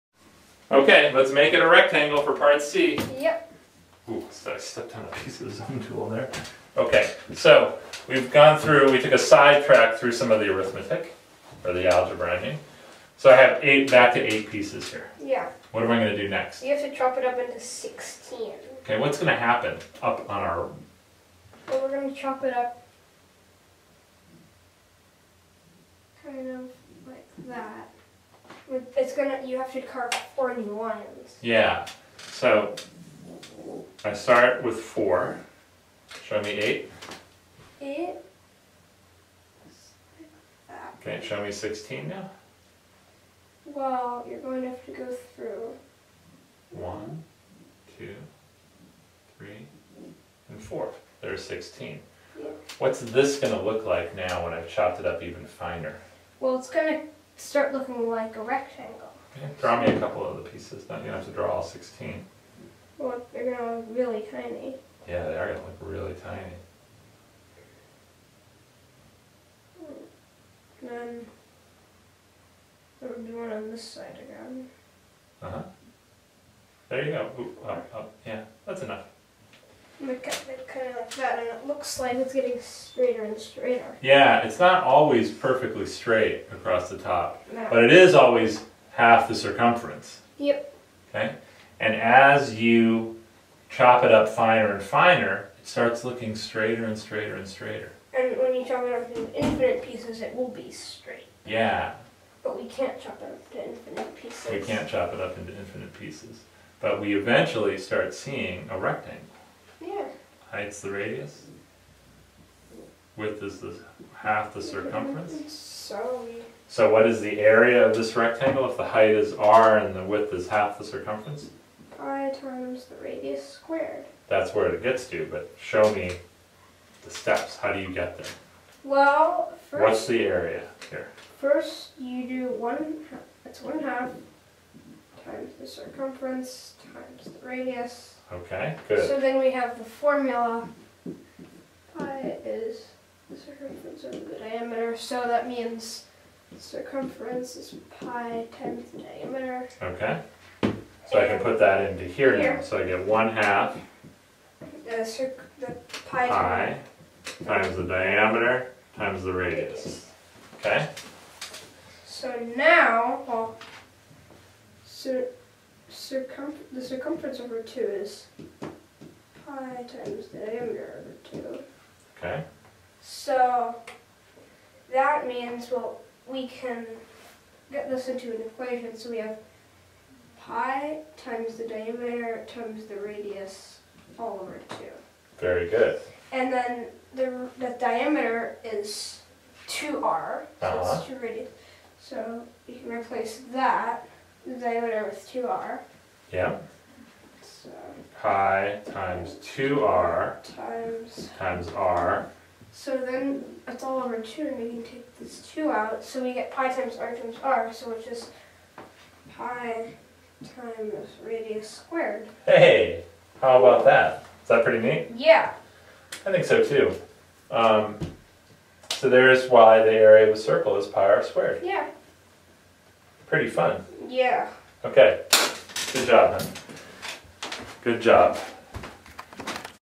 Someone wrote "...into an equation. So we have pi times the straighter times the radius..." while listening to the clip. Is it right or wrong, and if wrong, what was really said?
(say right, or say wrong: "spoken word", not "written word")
wrong: "diameter", not "straighter".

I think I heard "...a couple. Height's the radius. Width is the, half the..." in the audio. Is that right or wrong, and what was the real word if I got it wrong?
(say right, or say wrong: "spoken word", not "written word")
wrong: "rectangle", not "couple".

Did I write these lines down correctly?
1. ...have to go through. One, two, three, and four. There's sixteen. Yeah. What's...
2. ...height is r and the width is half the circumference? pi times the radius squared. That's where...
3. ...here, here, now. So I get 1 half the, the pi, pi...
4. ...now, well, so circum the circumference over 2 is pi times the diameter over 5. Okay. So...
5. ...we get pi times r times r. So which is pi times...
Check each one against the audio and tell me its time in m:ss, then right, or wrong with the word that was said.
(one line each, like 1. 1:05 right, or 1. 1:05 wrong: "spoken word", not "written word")
1. 0:44 right
2. 1:58 right
3. 2:32 right
4. 2:42 wrong: "2", not "5"
5. 3:26 right.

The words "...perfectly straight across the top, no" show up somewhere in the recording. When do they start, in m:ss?
1:25.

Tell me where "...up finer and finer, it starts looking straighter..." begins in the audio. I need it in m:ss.
1:34.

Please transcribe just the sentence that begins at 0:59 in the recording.
Okay, draw me a couple of the pieces.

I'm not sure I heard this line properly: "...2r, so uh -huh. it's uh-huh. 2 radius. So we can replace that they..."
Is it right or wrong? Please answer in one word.
right.